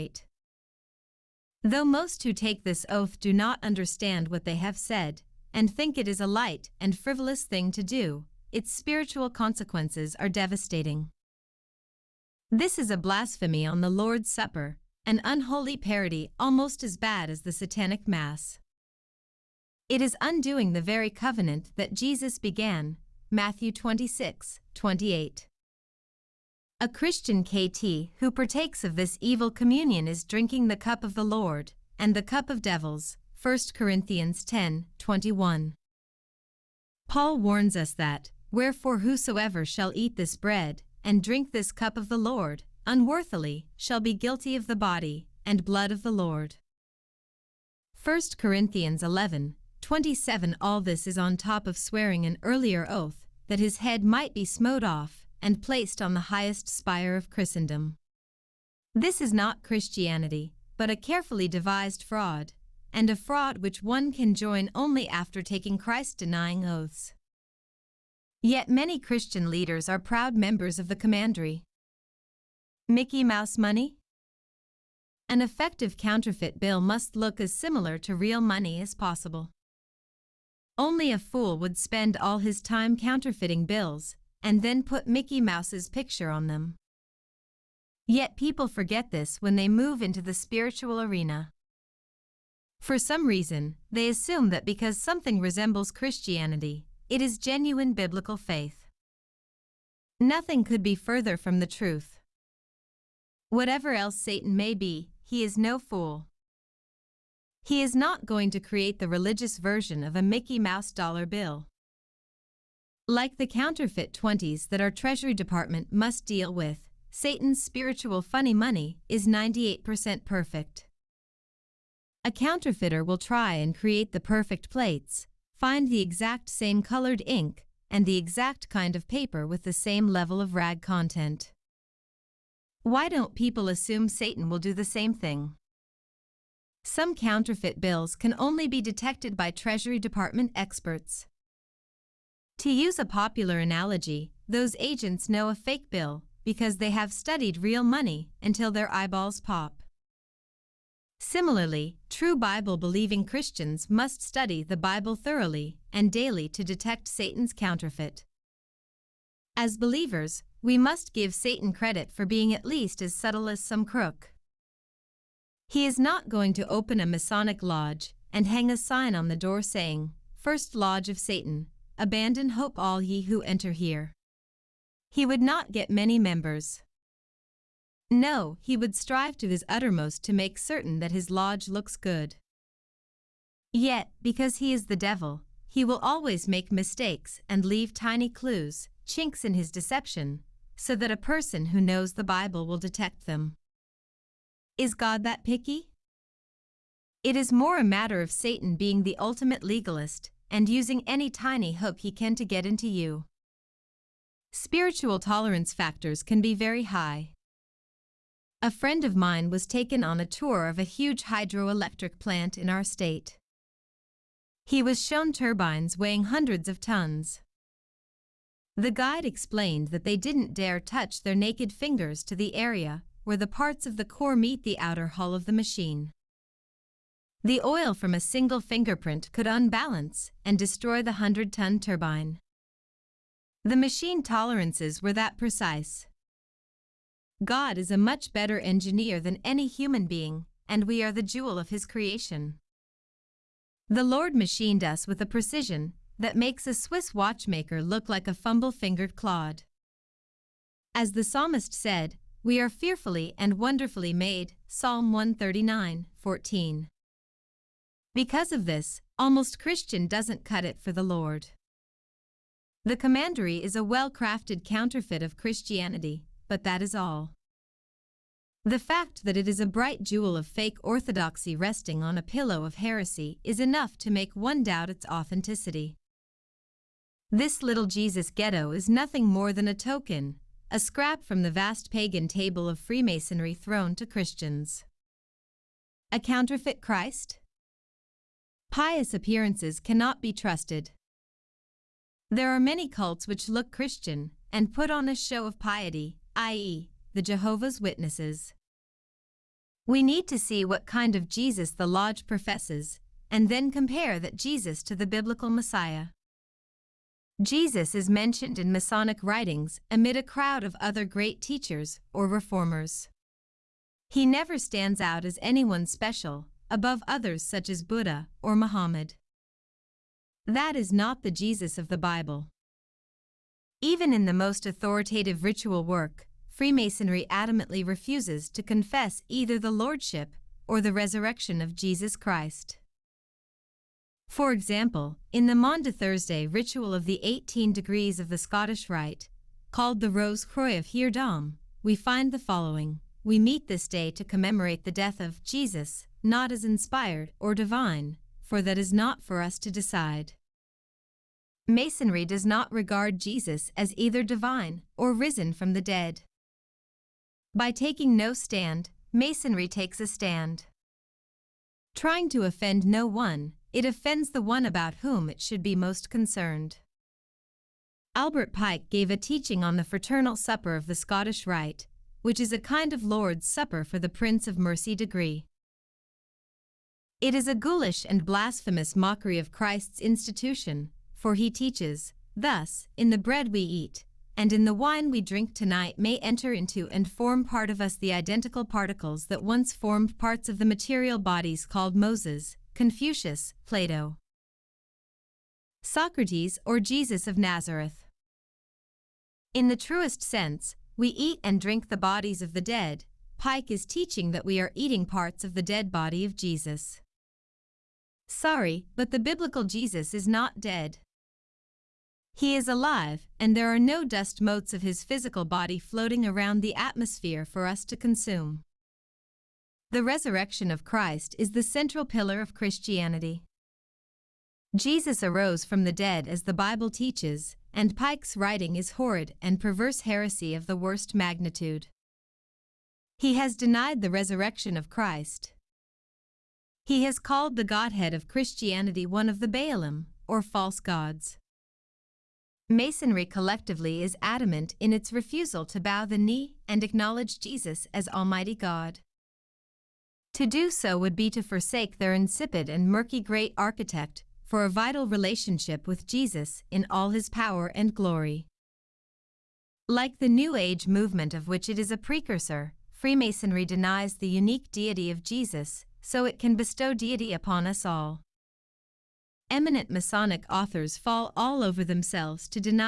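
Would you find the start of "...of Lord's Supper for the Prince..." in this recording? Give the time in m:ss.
6:12.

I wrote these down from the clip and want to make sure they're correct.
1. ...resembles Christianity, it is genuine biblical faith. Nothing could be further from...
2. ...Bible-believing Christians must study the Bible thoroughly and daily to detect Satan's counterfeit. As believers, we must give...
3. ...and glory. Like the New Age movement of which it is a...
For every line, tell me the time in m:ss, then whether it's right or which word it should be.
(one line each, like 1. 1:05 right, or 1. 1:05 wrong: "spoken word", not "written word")
1. 1:35 right
2. 2:32 right
3. 7:37 right.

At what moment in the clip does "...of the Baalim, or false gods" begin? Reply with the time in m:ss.
7:19.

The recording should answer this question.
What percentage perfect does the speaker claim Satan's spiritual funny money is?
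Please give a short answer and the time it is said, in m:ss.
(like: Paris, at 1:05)
98%, at 1:59.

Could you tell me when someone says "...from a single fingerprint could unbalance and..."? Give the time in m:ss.
3:47.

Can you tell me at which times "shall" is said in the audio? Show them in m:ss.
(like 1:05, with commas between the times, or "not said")
0:39, 0:43.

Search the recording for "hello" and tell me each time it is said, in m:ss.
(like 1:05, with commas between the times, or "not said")
not said.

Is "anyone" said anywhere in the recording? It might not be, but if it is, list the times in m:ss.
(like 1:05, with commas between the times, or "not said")
5:15.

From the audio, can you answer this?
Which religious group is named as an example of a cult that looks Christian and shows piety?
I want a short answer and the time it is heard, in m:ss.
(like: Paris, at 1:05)
Jehovah's Witnesses, at 4:57.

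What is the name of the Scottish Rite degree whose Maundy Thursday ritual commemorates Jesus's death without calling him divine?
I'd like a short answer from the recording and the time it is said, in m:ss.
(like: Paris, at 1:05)
Rose Croix of Heredom, at 5:40.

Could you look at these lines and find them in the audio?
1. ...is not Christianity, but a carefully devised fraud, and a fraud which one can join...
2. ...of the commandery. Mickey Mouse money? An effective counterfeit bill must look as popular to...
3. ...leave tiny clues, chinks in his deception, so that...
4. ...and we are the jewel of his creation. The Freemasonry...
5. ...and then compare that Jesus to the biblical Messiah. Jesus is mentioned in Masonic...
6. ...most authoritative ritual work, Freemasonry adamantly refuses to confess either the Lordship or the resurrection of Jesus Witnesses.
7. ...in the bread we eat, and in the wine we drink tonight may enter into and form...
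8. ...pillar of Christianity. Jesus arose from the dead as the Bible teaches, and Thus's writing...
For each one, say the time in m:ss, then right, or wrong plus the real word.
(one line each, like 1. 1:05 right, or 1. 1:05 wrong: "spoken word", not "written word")
1. 0:59 right
2. 1:10 wrong: "similar", not "popular"
3. 3:07 right
4. 4:00 wrong: "Lord", not "Freemasonry"
5. 5:03 right
6. 5:24 wrong: "Christ", not "Witnesses"
7. 6:22 right
8. 7:02 wrong: "Pike", not "Thus".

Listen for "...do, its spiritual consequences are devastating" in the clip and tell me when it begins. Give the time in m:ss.
0:07.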